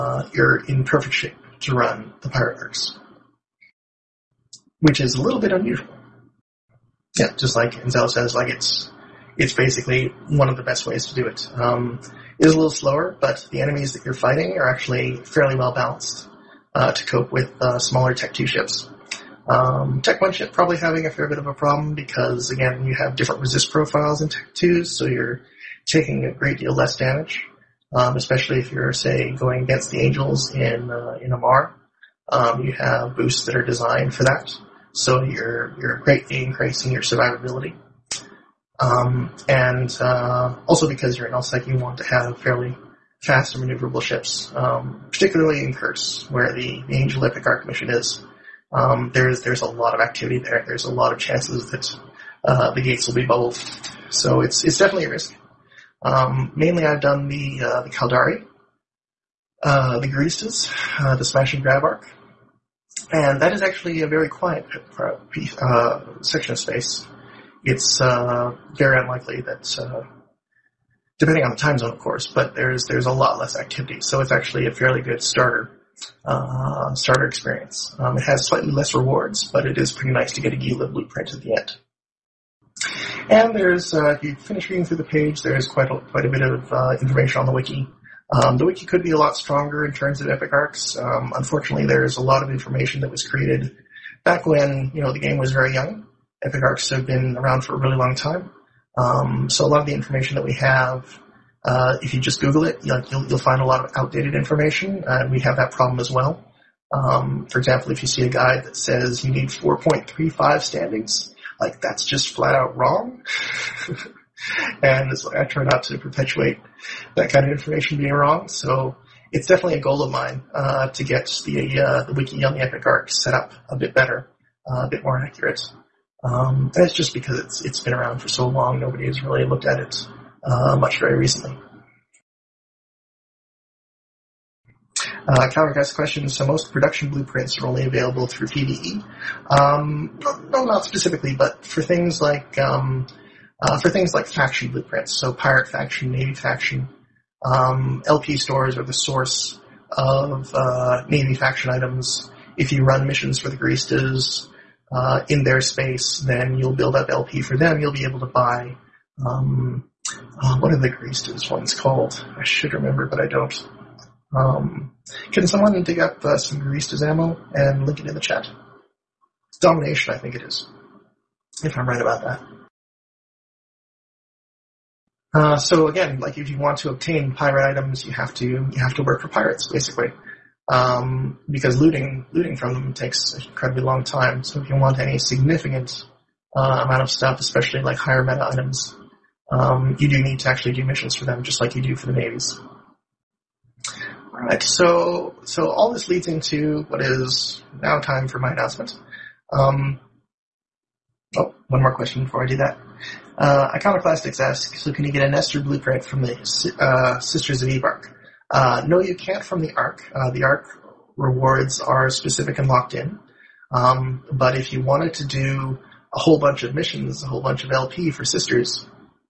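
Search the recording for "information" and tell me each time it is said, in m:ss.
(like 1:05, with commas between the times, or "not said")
1:27, 1:32, 1:39, 1:44, 1:57.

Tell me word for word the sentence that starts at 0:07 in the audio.
Yeah, just like Enzel says, like it's it's basically one of the best ways to do it.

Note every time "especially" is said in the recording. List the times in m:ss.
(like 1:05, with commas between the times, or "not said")
0:28, 3:07.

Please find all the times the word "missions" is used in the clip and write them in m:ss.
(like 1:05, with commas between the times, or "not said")
0:47, 2:33, 3:10, 3:36.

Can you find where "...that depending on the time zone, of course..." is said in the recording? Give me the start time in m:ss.
1:09.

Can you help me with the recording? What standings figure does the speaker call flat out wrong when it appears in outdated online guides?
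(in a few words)
4.35.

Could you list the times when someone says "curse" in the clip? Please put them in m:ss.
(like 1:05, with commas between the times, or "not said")
0:02, 0:45.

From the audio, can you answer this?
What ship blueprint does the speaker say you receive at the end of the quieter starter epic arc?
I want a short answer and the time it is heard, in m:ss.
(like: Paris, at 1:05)
Gila, at 1:20.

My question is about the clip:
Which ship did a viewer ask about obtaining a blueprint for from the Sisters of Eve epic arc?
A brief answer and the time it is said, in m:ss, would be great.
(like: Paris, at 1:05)
Nestor, at 3:25.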